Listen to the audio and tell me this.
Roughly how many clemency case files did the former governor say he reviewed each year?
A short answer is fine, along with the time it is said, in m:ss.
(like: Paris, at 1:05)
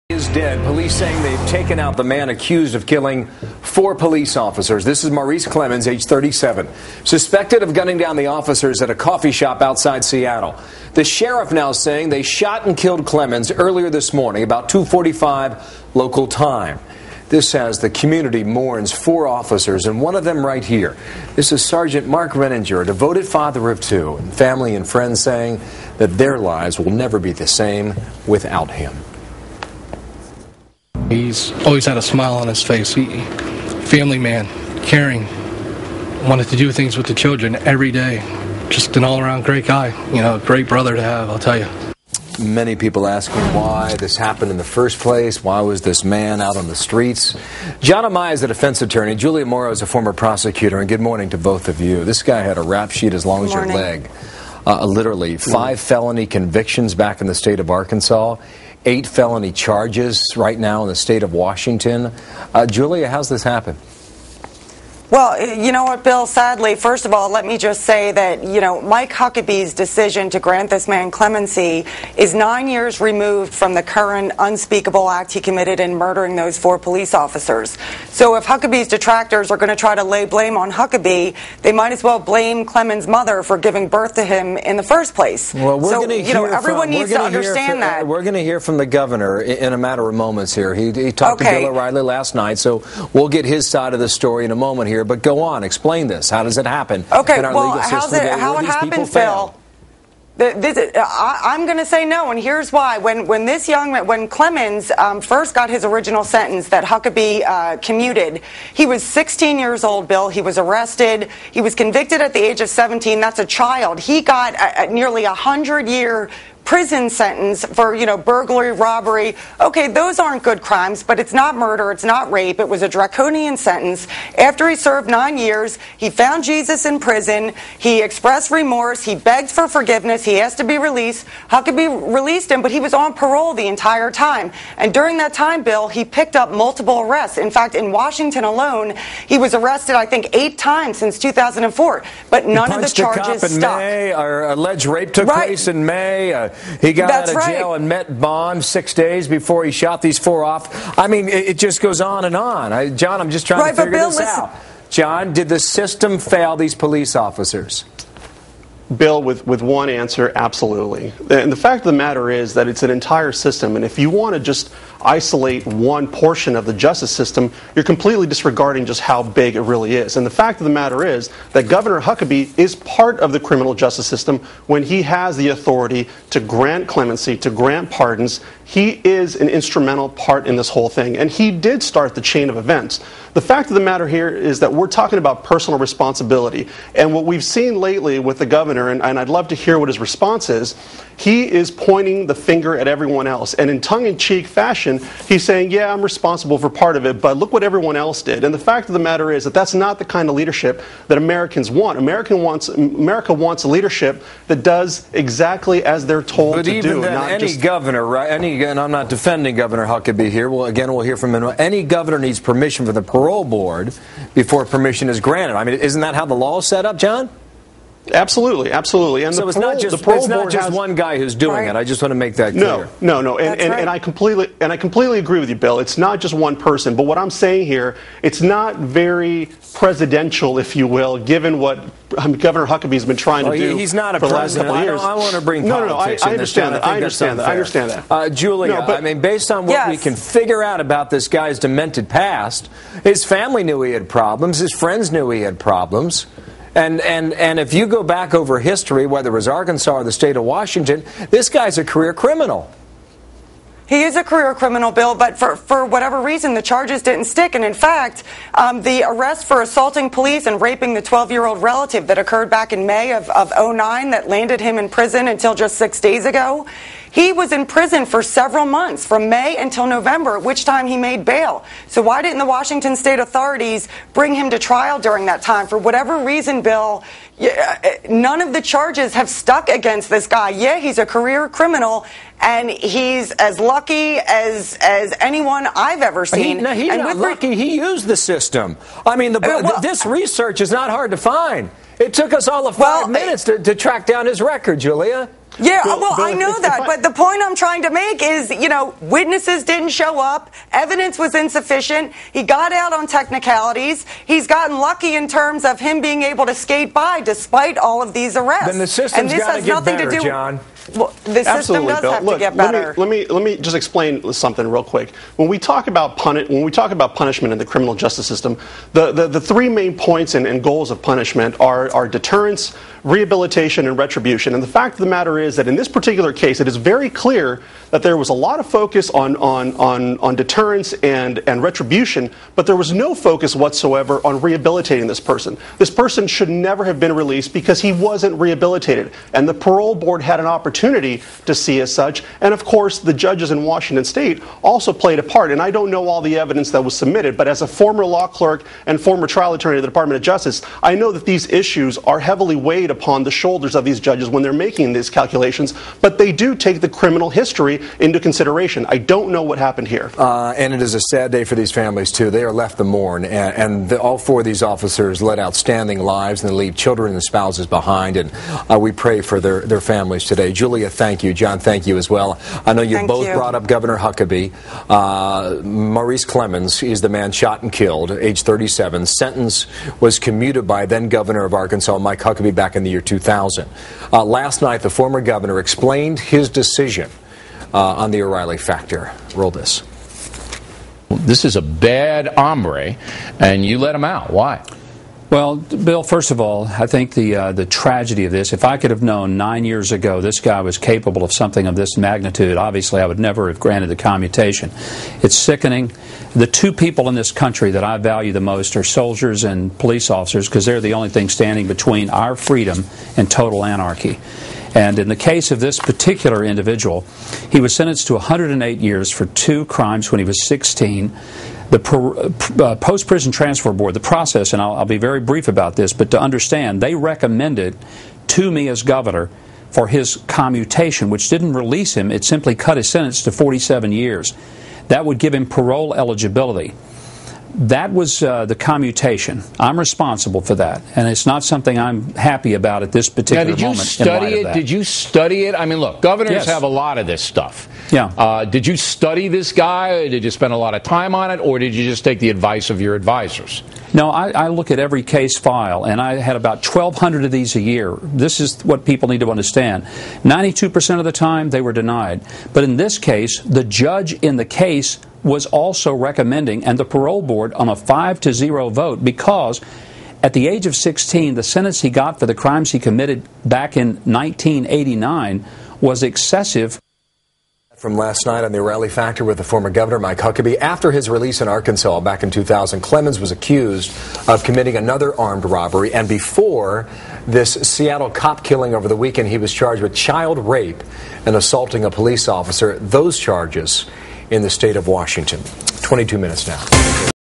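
1,200, at 7:36.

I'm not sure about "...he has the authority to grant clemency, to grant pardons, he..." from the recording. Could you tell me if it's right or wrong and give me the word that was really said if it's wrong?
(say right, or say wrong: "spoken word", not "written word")
right.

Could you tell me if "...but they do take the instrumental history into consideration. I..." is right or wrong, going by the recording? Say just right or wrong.
wrong.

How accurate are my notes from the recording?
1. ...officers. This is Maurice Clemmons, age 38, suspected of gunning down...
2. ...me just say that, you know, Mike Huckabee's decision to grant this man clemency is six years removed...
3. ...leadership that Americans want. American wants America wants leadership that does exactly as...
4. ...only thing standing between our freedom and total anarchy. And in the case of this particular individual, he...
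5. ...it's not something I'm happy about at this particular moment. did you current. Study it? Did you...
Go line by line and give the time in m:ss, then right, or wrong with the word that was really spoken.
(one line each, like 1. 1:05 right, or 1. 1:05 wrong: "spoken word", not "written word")
1. 0:04 wrong: "37", not "38"
2. 1:07 wrong: "nine", not "six"
3. 3:20 right
4. 6:50 right
5. 7:21 wrong: "moment", not "current".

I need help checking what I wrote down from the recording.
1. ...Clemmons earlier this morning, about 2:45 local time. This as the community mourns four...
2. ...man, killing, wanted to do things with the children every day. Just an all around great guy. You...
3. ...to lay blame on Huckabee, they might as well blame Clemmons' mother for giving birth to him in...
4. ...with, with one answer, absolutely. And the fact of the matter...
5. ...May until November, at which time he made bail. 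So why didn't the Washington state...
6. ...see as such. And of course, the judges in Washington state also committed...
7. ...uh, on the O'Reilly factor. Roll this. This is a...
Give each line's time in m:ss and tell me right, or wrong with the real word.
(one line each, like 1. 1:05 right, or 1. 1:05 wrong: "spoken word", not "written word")
1. 0:13 right
2. 0:34 wrong: "caring", not "killing"
3. 1:19 right
4. 2:39 right
5. 4:29 right
6. 5:41 wrong: "played", not "committed"
7. 6:27 right.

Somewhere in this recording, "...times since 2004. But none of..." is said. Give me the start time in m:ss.
2:20.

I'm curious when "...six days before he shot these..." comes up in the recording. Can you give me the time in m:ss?
2:28.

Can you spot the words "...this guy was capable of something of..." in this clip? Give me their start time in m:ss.
6:40.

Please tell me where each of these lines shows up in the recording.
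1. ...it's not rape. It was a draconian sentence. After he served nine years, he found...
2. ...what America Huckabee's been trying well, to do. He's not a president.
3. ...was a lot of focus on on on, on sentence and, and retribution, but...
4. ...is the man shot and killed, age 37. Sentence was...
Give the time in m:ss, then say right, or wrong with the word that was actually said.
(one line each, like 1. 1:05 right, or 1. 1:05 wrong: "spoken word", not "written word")
1. 2:01 right
2. 3:51 wrong: "Governor", not "America"
3. 5:28 wrong: "deterrence", not "sentence"
4. 6:16 right.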